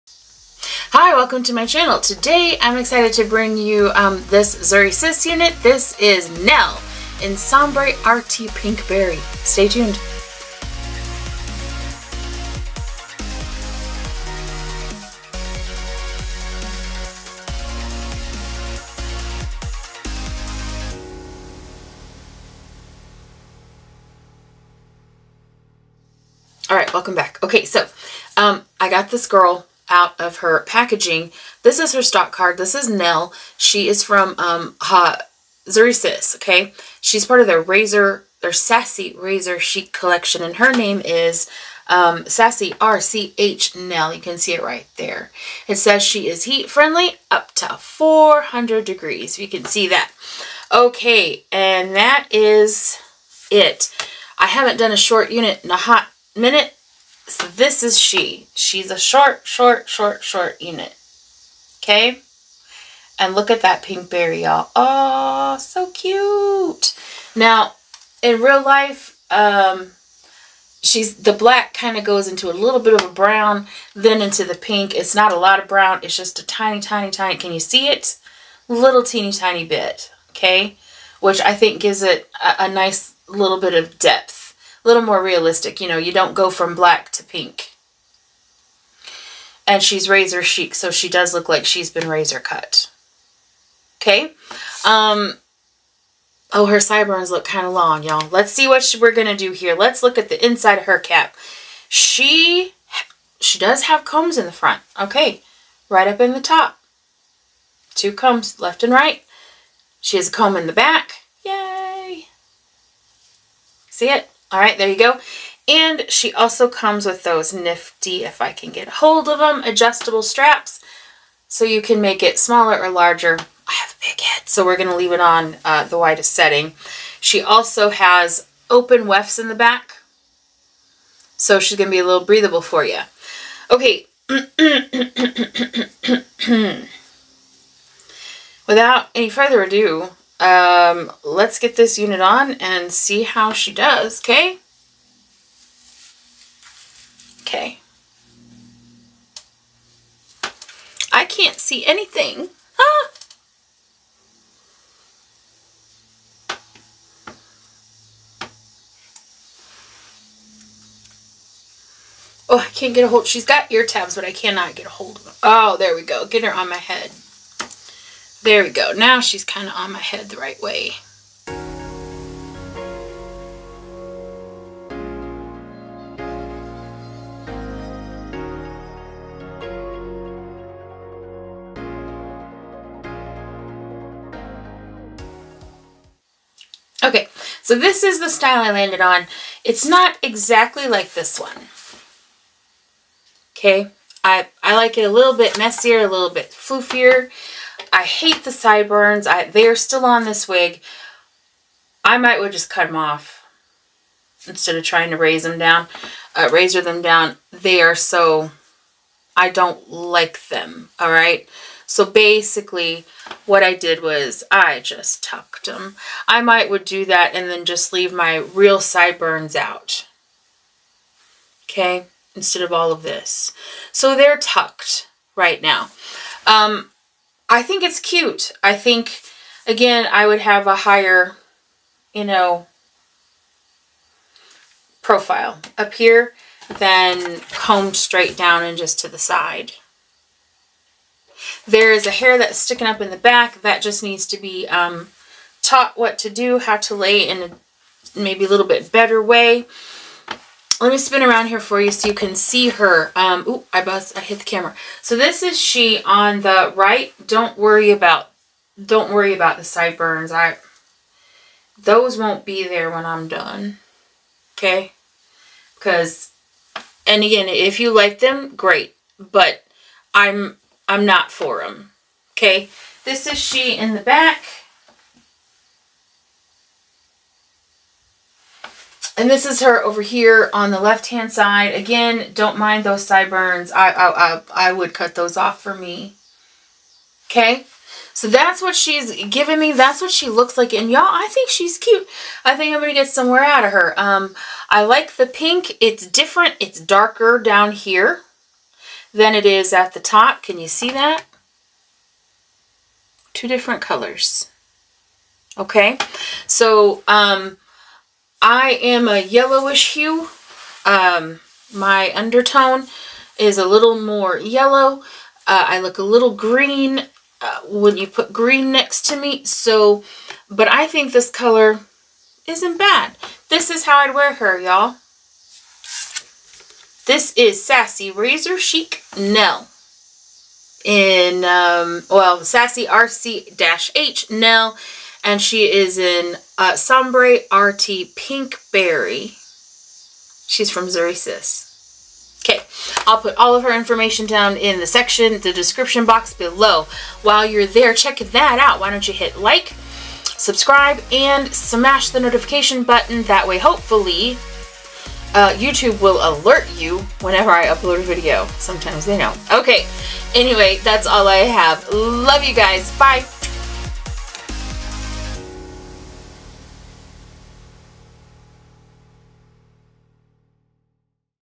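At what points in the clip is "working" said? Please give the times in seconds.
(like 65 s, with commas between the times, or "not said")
not said.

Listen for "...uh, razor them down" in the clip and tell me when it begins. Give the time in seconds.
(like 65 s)
206 s.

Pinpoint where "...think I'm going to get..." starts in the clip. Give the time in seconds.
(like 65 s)
292 s.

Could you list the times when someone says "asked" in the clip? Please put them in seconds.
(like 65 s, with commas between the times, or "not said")
not said.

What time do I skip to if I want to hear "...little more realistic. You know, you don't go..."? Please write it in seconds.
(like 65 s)
84 s.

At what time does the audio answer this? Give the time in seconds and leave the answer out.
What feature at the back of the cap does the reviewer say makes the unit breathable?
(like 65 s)
128 s.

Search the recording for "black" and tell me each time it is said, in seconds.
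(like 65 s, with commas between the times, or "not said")
71 s, 86 s.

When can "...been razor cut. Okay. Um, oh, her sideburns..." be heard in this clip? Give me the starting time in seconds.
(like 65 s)
91 s.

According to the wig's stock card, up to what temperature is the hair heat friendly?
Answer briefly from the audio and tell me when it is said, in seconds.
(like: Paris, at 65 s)
400 degrees, at 47 s.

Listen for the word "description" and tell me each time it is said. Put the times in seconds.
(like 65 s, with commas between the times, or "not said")
345 s.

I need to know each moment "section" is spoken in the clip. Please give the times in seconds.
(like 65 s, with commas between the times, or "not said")
344 s.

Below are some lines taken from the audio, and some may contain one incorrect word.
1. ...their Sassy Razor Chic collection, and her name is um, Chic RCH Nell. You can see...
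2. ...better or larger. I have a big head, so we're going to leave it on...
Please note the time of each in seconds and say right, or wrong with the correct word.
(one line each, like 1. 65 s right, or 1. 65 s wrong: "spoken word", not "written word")
1. 38 s wrong: "Sassy", not "Chic"
2. 122 s wrong: "smaller", not "better".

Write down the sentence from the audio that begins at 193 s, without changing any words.
Okay, I, I like it a little bit messier, a little bit floofier.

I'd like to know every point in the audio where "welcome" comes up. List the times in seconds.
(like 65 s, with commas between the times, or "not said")
1 s, 26 s.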